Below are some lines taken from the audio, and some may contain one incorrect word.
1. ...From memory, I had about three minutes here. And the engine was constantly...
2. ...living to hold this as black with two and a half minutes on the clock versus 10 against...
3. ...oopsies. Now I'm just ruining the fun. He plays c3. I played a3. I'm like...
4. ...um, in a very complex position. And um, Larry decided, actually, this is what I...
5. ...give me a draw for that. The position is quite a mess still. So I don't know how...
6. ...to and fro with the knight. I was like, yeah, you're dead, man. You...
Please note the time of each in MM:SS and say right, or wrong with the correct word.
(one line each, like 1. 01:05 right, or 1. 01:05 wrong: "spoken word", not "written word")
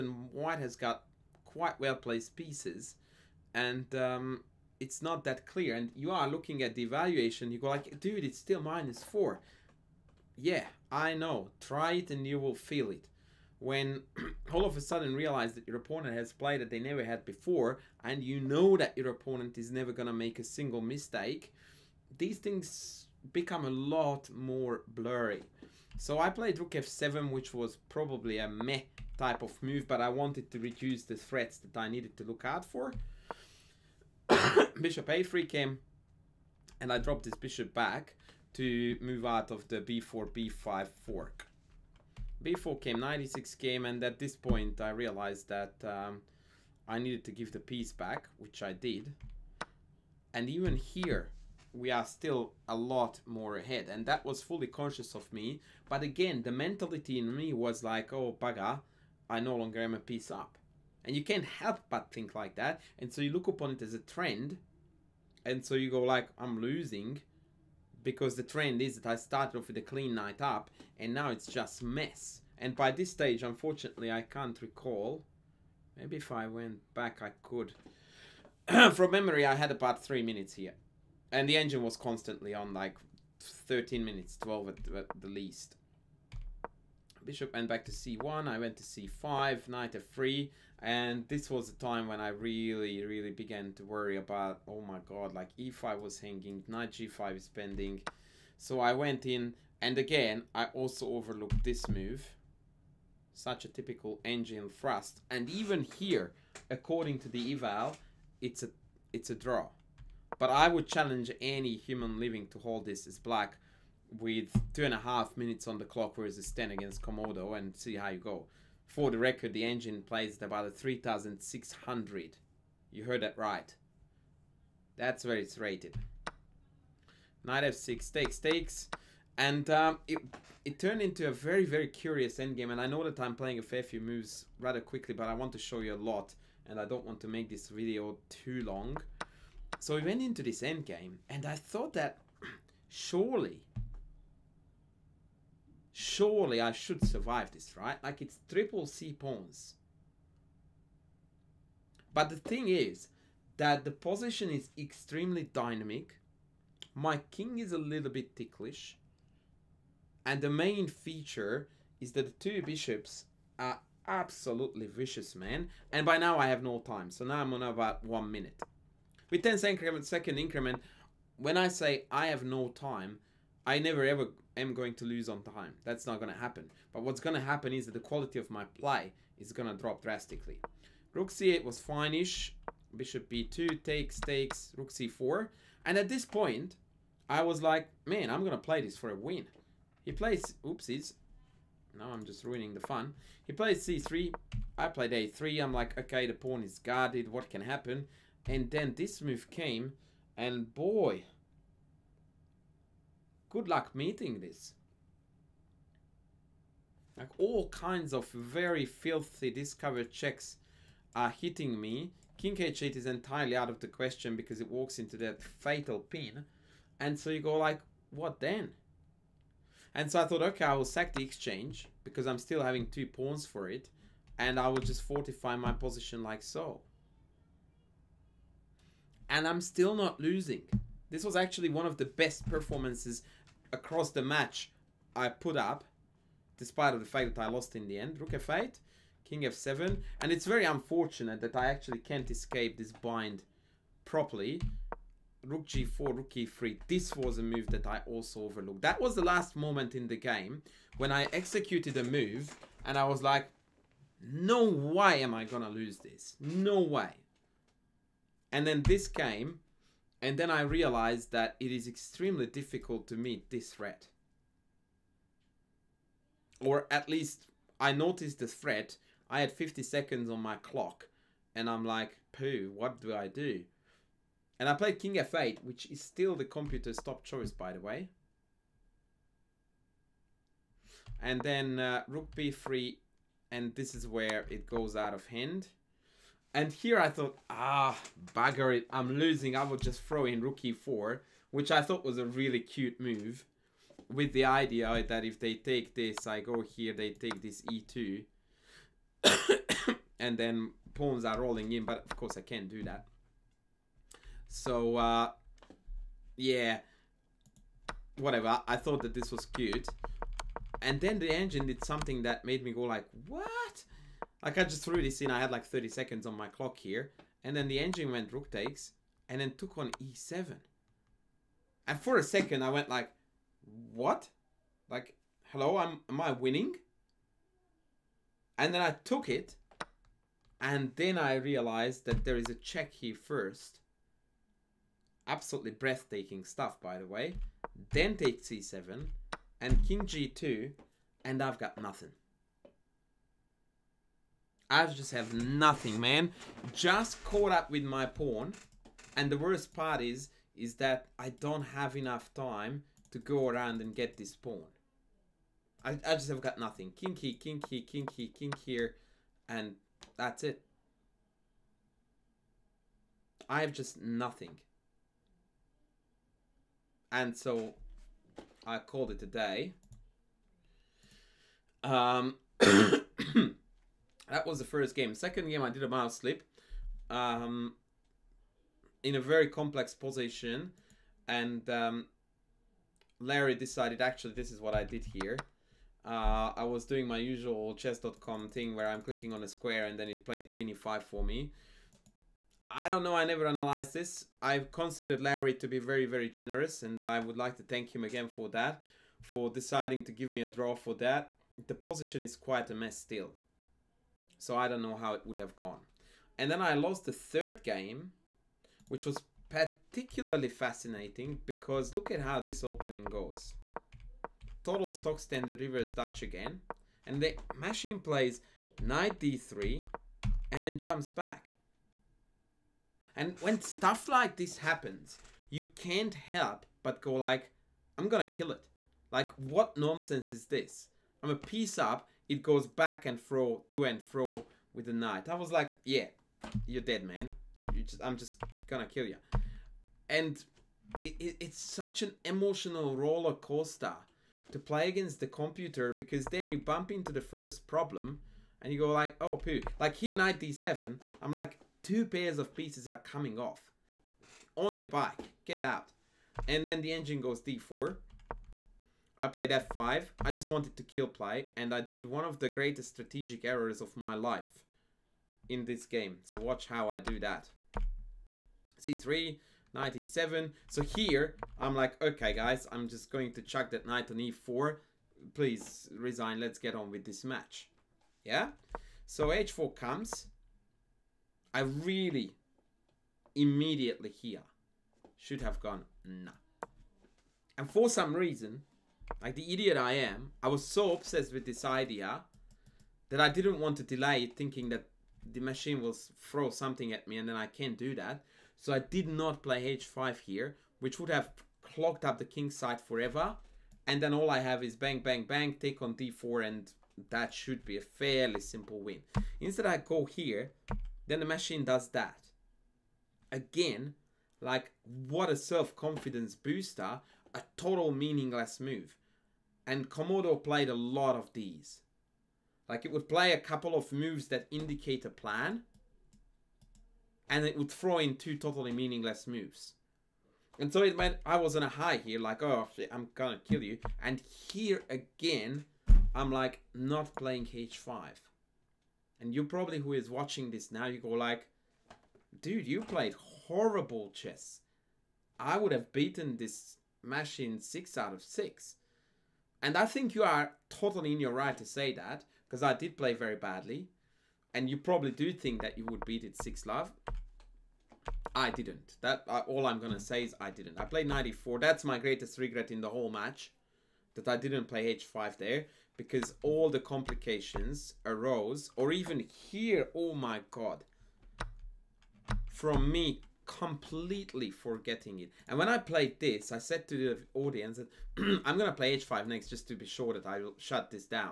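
1. 01:18 right
2. 01:52 right
3. 03:10 right
4. 06:17 right
5. 06:40 right
6. 07:13 right.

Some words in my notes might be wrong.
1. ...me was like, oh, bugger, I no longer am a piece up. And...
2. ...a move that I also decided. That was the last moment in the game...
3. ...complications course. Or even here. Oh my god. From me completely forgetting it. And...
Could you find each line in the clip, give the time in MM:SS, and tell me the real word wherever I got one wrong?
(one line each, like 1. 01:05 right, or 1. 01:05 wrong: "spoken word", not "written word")
1. 00:57 right
2. 04:07 wrong: "overlooked", not "decided"
3. 09:26 wrong: "arose", not "course".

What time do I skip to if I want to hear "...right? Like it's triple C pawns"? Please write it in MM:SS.
02:27.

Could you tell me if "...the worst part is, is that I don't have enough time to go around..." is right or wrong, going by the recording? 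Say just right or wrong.
right.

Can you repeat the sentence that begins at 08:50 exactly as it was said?
And so it meant I was on a high here, like, oh shit, I'm gonna kill you.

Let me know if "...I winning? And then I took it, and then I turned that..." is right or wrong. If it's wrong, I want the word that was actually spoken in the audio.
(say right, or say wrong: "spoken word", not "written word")
wrong: "realized", not "turned".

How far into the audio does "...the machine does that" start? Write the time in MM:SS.
08:31.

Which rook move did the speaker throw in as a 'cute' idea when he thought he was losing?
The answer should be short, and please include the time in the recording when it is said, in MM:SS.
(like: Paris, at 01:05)
Rook e4, at 04:50.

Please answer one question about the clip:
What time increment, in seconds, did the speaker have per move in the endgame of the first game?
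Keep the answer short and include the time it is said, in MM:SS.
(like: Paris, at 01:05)
10, at 02:49.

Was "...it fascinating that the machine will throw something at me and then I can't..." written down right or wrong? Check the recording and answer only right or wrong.
wrong.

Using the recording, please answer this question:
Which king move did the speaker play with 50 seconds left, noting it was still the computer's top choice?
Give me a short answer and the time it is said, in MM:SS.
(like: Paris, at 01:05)
King f8, at 04:34.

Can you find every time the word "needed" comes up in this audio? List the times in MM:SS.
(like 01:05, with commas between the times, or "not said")
00:31, 00:46.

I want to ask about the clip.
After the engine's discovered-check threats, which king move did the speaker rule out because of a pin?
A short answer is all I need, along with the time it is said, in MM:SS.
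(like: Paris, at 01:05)
King h8, at 03:32.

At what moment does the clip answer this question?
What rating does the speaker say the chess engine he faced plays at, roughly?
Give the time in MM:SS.
02:00.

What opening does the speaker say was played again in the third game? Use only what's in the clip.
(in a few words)
Reverse Dutch.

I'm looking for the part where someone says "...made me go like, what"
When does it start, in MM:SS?
05:12.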